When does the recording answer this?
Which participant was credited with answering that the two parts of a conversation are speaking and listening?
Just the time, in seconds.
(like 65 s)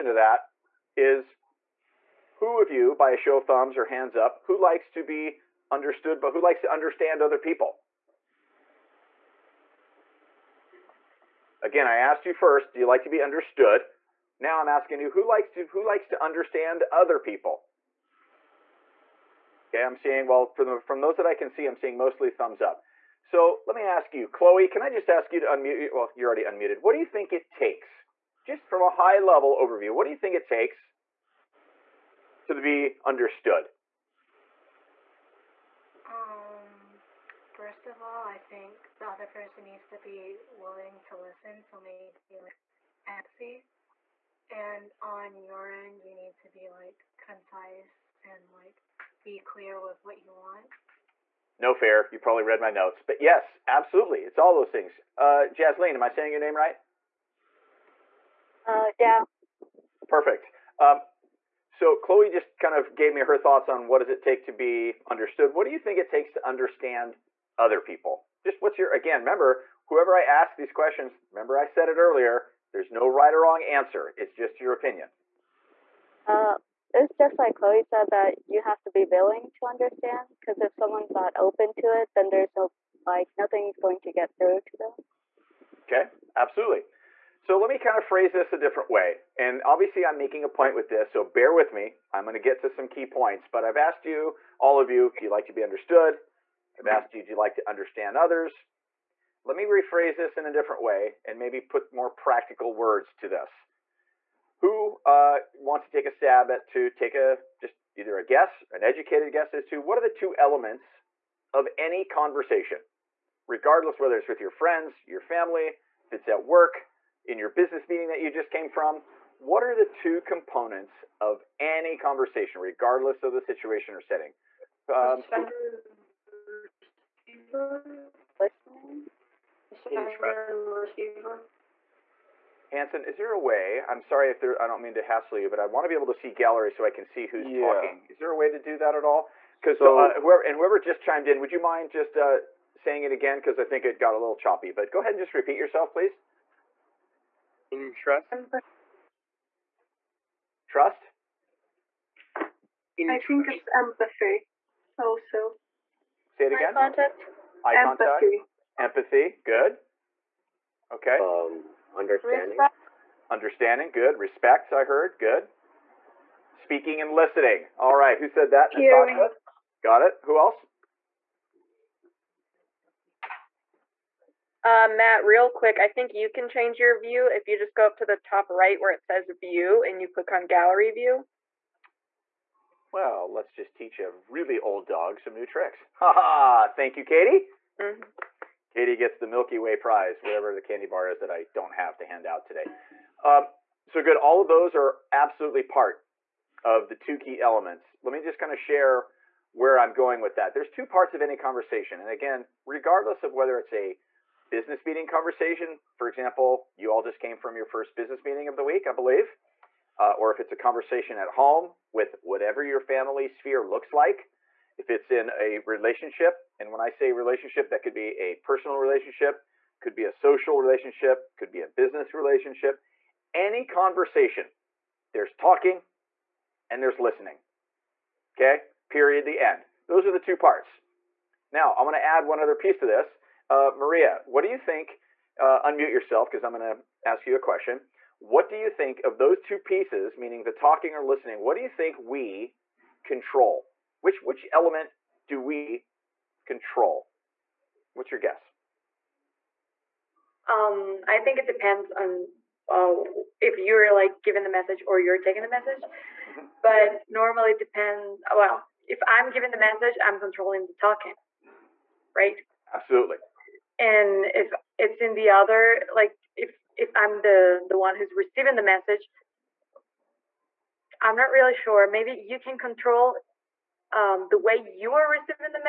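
169 s.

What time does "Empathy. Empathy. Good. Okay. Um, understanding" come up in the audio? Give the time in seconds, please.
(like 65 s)
158 s.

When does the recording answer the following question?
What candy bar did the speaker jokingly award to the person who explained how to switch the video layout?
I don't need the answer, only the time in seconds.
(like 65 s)
189 s.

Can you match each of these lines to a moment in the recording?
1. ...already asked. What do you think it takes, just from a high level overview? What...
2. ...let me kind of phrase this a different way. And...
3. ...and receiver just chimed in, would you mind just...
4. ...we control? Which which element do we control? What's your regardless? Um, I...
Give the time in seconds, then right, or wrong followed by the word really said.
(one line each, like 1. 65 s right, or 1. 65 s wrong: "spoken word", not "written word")
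1. 26 s wrong: "unmuted", not "asked"
2. 87 s right
3. 140 s wrong: "whoever", not "receiver"
4. 241 s wrong: "guess", not "regardless".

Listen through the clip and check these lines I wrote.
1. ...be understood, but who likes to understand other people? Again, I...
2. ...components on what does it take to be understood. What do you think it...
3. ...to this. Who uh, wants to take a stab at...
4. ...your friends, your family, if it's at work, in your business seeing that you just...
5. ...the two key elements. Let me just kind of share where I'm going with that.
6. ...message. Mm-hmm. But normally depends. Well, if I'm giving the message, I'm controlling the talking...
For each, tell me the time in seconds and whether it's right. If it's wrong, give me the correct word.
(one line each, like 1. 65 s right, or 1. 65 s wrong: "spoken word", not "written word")
1. 5 s right
2. 63 s wrong: "thoughts", not "components"
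3. 103 s right
4. 114 s wrong: "meeting", not "seeing"
5. 196 s right
6. 255 s right.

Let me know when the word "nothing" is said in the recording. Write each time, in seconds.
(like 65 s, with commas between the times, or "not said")
83 s.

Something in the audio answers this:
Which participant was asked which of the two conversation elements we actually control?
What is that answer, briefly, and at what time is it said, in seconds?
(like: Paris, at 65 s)
Maria, at 233 s.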